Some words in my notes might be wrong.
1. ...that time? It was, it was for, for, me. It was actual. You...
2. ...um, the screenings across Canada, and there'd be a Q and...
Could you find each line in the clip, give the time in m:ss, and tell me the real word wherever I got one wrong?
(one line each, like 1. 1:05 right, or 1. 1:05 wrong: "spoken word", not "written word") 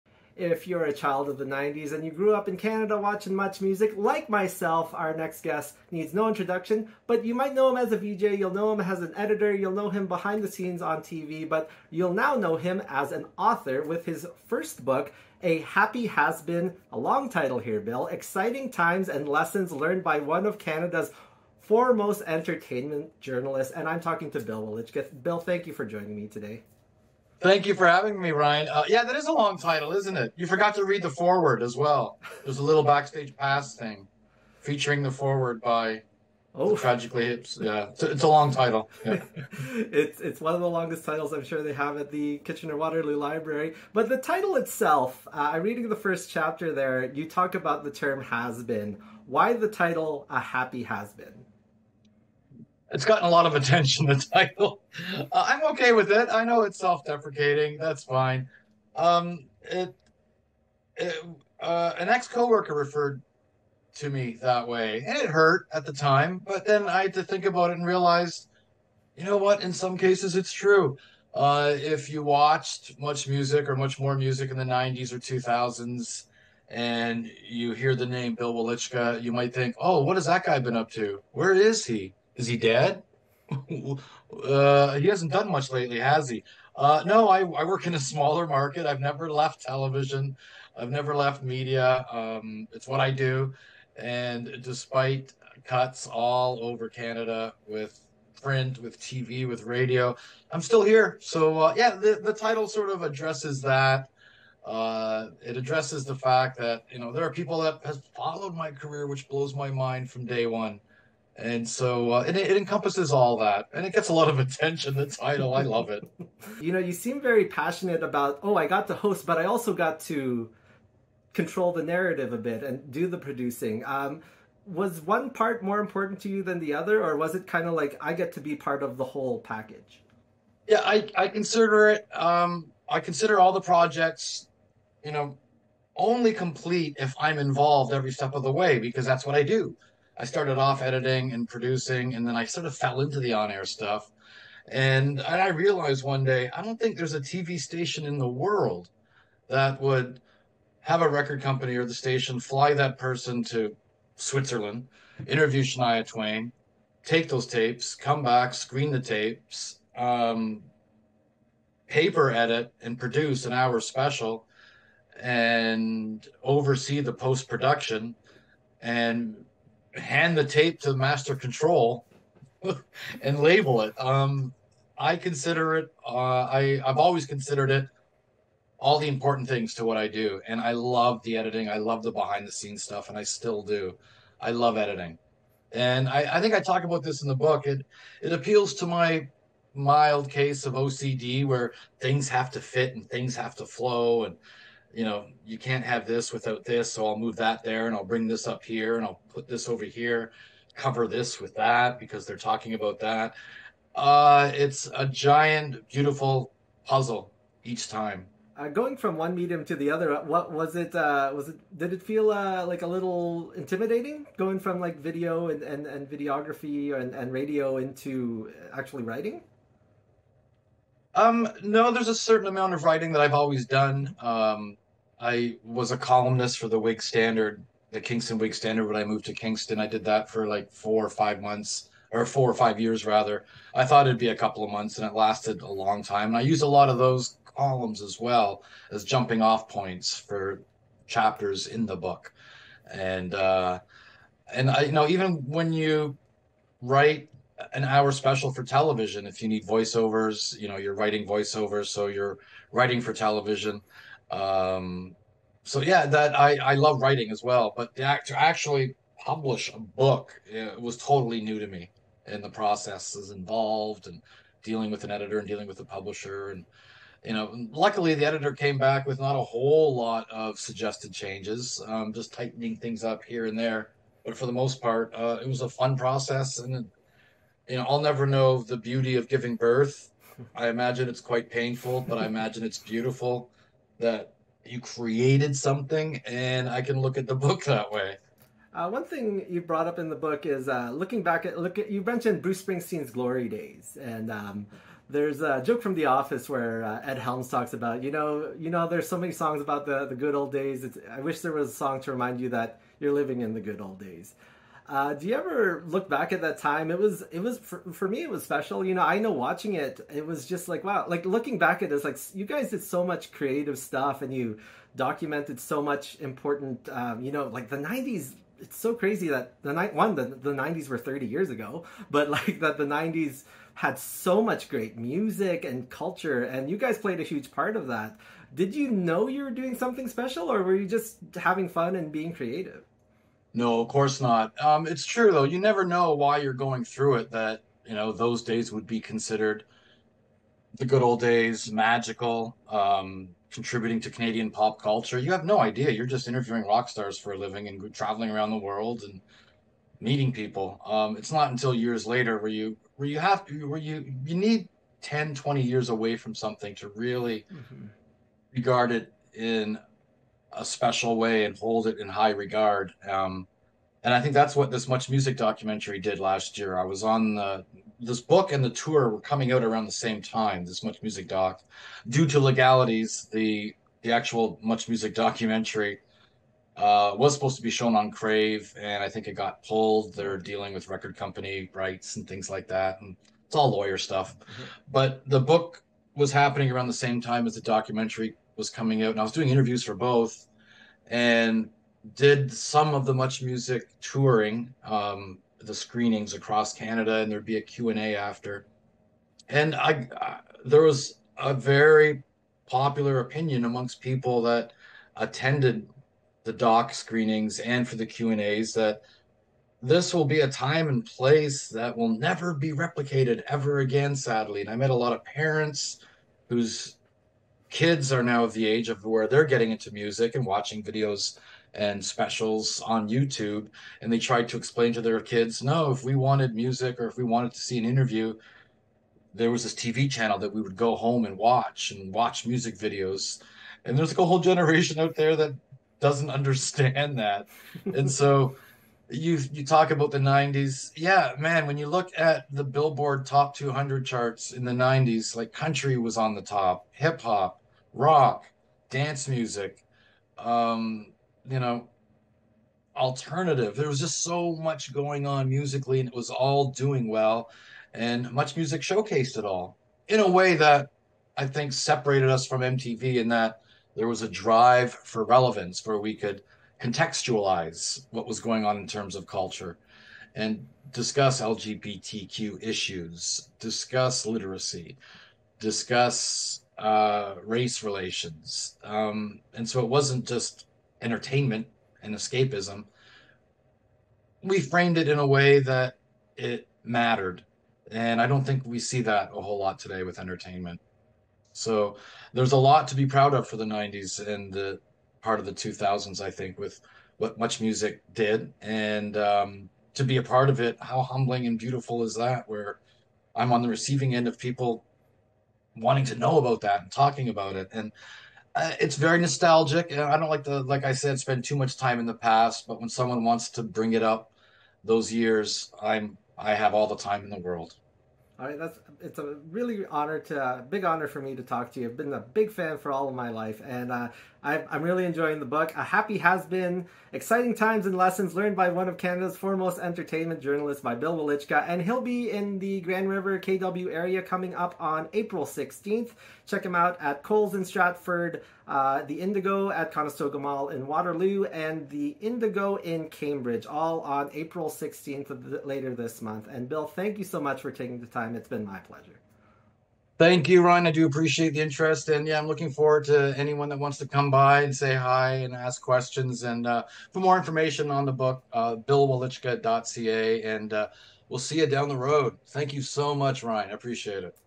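1. 5:06 wrong: "special", not "actual"
2. 6:34 right.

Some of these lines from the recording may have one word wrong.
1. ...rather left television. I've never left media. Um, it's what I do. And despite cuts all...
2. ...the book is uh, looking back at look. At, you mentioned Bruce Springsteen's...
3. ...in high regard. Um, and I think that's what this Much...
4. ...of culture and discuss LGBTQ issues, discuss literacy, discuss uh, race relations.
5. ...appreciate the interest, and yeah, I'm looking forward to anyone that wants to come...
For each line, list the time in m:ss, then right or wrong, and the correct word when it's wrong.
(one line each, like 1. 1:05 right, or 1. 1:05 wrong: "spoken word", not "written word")
1. 1:29 wrong: "never", not "rather"
2. 4:50 right
3. 6:01 right
4. 7:49 right
5. 9:11 right.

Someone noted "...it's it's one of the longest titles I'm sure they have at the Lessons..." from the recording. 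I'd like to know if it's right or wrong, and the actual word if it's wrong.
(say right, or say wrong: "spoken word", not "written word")
wrong: "Kitchener", not "Lessons".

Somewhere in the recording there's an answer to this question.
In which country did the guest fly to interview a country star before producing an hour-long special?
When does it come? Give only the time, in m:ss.
2:34.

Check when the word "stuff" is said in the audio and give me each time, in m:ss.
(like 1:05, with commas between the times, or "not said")
2:23, 3:02, 5:13, 6:23.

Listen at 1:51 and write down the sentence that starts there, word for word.
And so uh, it, it encompasses all that, and it gets a lot of attention.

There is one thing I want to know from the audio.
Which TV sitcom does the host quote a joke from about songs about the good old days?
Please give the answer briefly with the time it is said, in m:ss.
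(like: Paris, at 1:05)
The Office, at 4:55.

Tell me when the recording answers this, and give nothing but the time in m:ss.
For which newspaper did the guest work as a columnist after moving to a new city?
3:48.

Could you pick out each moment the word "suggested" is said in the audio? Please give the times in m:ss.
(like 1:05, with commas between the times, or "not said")
4:30.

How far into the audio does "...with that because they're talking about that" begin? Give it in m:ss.
3:21.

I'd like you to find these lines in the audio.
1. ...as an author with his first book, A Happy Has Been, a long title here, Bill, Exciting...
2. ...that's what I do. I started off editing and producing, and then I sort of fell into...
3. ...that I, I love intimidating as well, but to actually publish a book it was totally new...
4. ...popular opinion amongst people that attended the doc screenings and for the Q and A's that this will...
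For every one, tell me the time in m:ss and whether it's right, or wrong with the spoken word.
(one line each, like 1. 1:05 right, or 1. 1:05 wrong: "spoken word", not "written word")
1. 0:12 right
2. 2:19 right
3. 4:16 wrong: "writing", not "intimidating"
4. 6:42 right.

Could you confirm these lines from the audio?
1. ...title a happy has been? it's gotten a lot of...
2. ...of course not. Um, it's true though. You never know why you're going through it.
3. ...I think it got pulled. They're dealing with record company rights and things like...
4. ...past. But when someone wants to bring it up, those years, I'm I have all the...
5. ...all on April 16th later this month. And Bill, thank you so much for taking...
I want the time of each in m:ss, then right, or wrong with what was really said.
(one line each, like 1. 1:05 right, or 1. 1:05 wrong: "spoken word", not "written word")
1. 0:49 right
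2. 5:33 right
3. 6:19 right
4. 8:32 right
5. 9:03 right.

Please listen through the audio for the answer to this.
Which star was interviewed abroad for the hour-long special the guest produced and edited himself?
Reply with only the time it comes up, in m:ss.
2:35.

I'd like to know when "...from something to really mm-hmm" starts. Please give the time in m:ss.
5:56.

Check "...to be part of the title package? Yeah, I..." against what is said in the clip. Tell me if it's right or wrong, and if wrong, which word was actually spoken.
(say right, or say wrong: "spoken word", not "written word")
wrong: "whole", not "title".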